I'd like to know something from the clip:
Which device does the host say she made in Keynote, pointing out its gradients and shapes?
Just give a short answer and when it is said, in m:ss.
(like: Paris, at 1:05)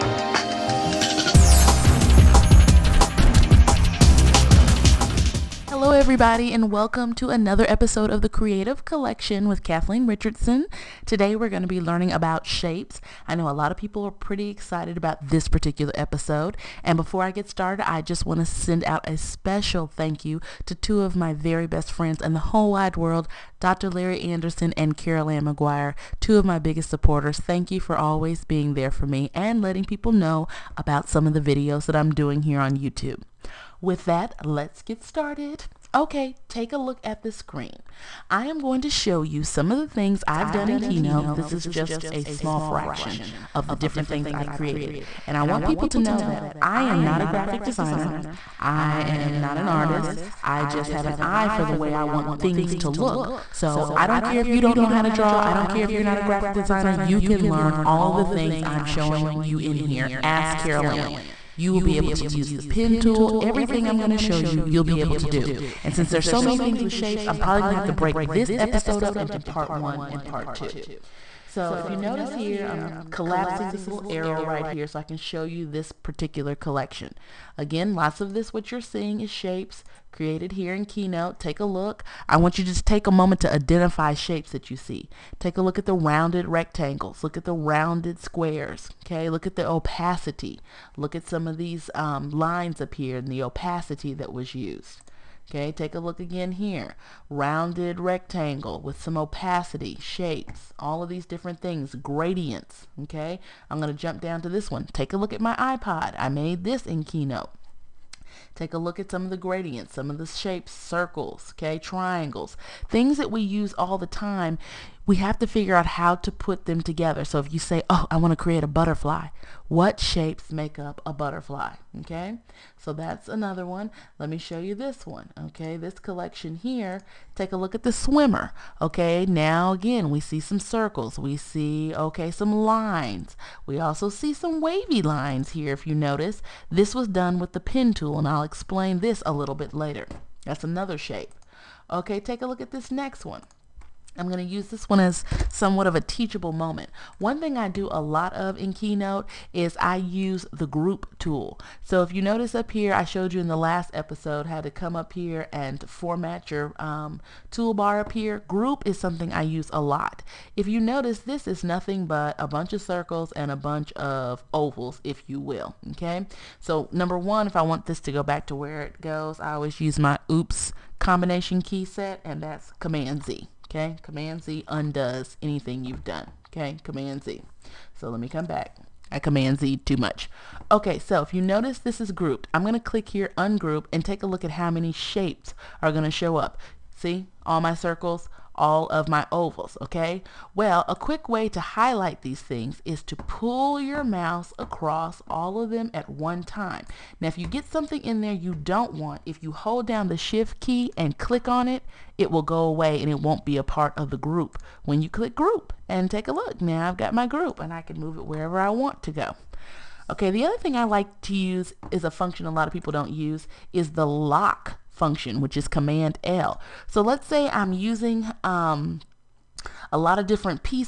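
iPod, at 1:45.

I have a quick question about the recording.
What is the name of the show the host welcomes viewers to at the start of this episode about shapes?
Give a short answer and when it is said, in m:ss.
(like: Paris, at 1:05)
Cre8tiv Collection, at 0:08.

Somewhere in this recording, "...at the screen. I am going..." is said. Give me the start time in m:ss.
0:37.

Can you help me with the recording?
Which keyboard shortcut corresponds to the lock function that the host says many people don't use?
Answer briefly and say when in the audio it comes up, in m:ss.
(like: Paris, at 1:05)
Command L, at 3:35.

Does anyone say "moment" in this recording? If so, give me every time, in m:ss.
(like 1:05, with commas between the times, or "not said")
1:23, 2:26.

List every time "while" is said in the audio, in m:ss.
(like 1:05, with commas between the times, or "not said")
not said.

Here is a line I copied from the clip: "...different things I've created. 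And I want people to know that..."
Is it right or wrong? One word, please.
right.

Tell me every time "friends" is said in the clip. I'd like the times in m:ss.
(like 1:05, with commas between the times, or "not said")
0:21.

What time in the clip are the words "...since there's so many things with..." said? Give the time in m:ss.
1:05.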